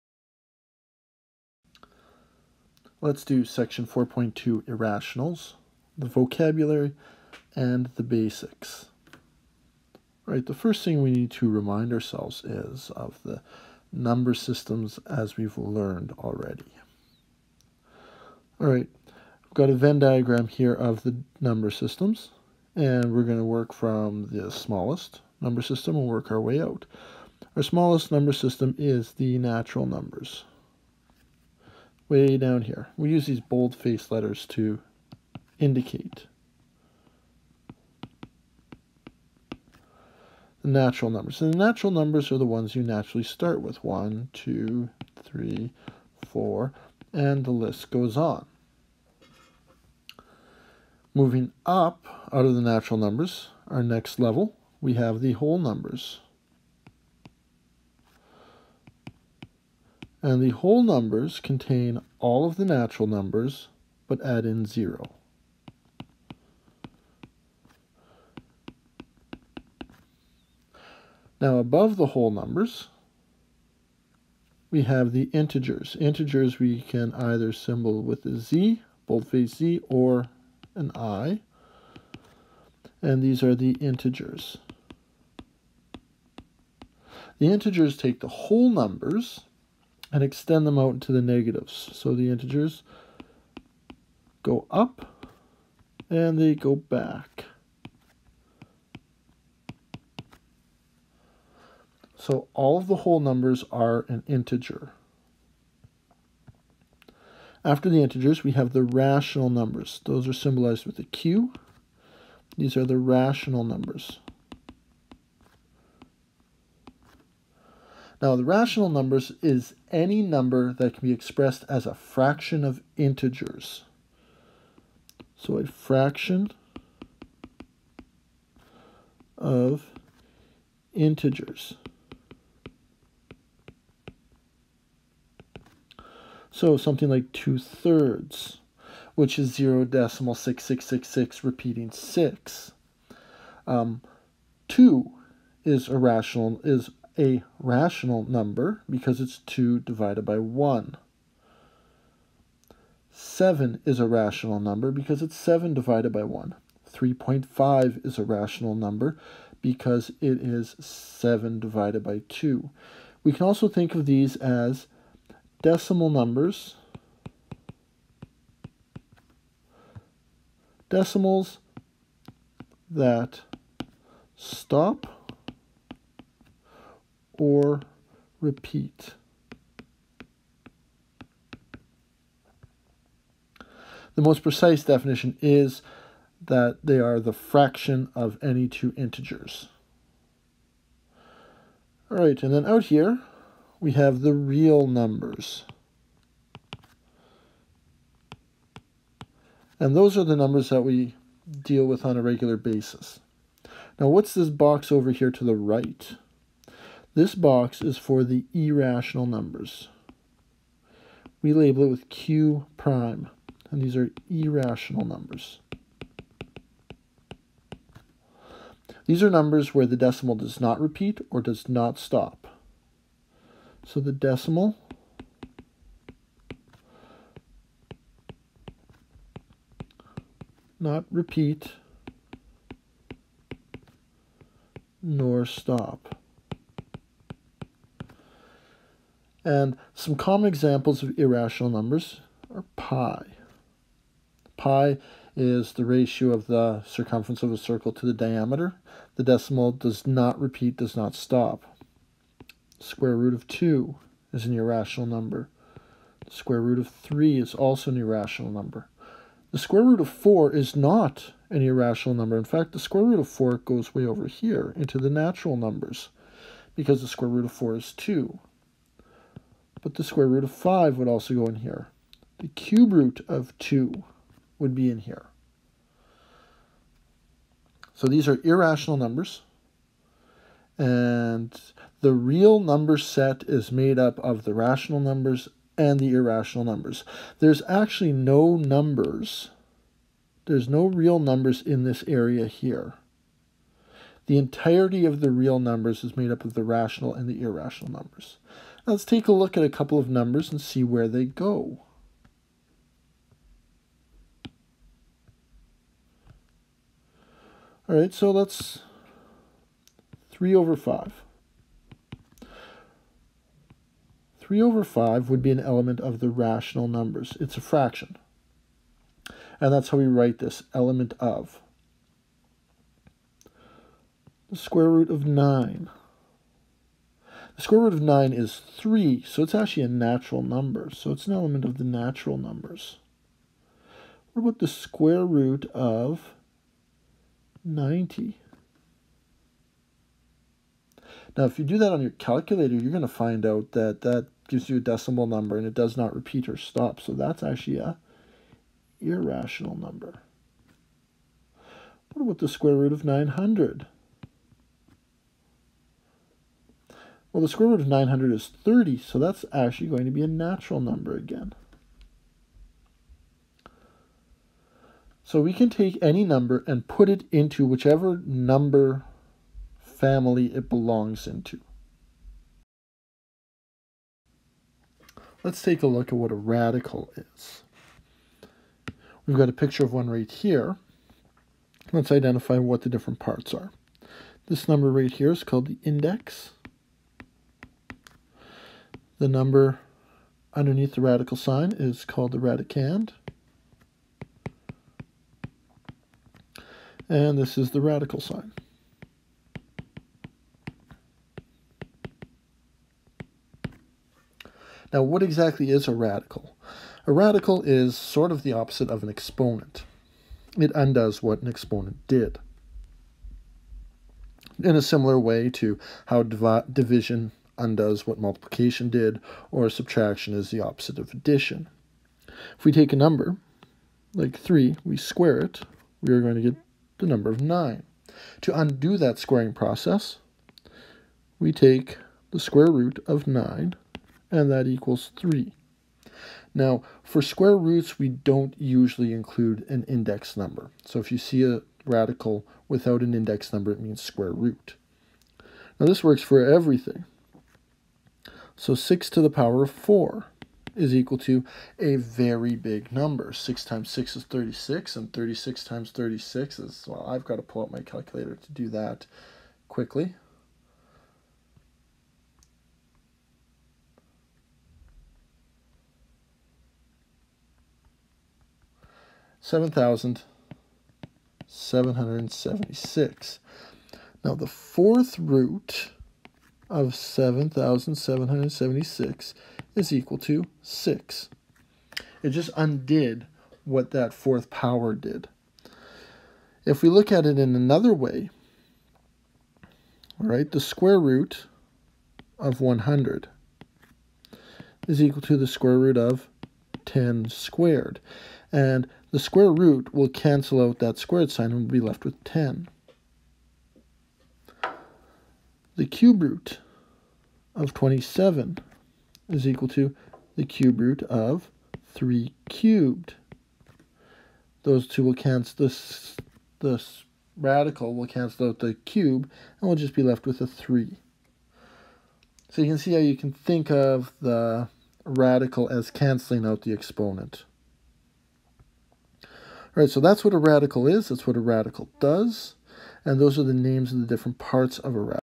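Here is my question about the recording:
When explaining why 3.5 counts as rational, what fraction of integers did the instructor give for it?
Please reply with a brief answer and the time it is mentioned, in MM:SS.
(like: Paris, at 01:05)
7 divided by 2, at 02:40.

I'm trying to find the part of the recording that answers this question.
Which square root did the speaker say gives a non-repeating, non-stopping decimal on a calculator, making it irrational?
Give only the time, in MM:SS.
05:34.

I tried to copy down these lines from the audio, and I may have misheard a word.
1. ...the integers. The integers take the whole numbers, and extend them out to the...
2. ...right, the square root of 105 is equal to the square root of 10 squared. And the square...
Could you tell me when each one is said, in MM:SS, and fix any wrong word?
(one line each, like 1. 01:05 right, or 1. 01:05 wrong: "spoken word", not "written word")
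1. 01:23 right
2. 08:10 wrong: "100", not "105".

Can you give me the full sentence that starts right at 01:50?
Those are symbolized with a Q.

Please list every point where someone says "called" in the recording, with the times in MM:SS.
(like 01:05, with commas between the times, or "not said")
06:25, 06:32.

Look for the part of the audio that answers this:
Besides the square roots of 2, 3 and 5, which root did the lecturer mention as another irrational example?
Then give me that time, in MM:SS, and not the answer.
04:32.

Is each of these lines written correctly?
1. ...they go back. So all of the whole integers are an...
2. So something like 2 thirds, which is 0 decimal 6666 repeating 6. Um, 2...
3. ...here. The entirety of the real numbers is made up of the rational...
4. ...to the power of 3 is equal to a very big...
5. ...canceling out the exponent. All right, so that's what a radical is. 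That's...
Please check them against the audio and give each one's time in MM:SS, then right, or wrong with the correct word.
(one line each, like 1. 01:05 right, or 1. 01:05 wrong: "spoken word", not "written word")
1. 01:36 wrong: "numbers", not "integers"
2. 02:16 right
3. 04:52 right
4. 07:29 wrong: "4", not "3"
5. 08:45 right.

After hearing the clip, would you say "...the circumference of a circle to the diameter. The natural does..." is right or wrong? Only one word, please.
wrong.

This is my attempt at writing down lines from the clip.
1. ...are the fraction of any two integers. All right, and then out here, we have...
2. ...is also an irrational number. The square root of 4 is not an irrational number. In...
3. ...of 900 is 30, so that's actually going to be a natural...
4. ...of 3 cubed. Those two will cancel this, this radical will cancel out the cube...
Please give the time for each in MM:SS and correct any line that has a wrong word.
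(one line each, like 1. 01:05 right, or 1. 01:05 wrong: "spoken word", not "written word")
1. 03:06 right
2. 04:17 right
3. 05:57 right
4. 08:31 right.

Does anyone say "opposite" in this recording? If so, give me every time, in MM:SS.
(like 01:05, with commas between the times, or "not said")
06:48, 07:00.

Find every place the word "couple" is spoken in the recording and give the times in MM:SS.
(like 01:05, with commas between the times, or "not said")
04:59.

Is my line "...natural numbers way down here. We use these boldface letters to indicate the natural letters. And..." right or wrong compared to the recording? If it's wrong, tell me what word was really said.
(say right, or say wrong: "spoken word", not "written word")
wrong: "numbers", not "letters".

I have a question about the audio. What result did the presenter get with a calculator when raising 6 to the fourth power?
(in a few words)
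7,776.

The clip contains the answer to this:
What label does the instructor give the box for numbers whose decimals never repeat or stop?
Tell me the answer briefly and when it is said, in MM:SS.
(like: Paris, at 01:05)
Q prime, at 03:32.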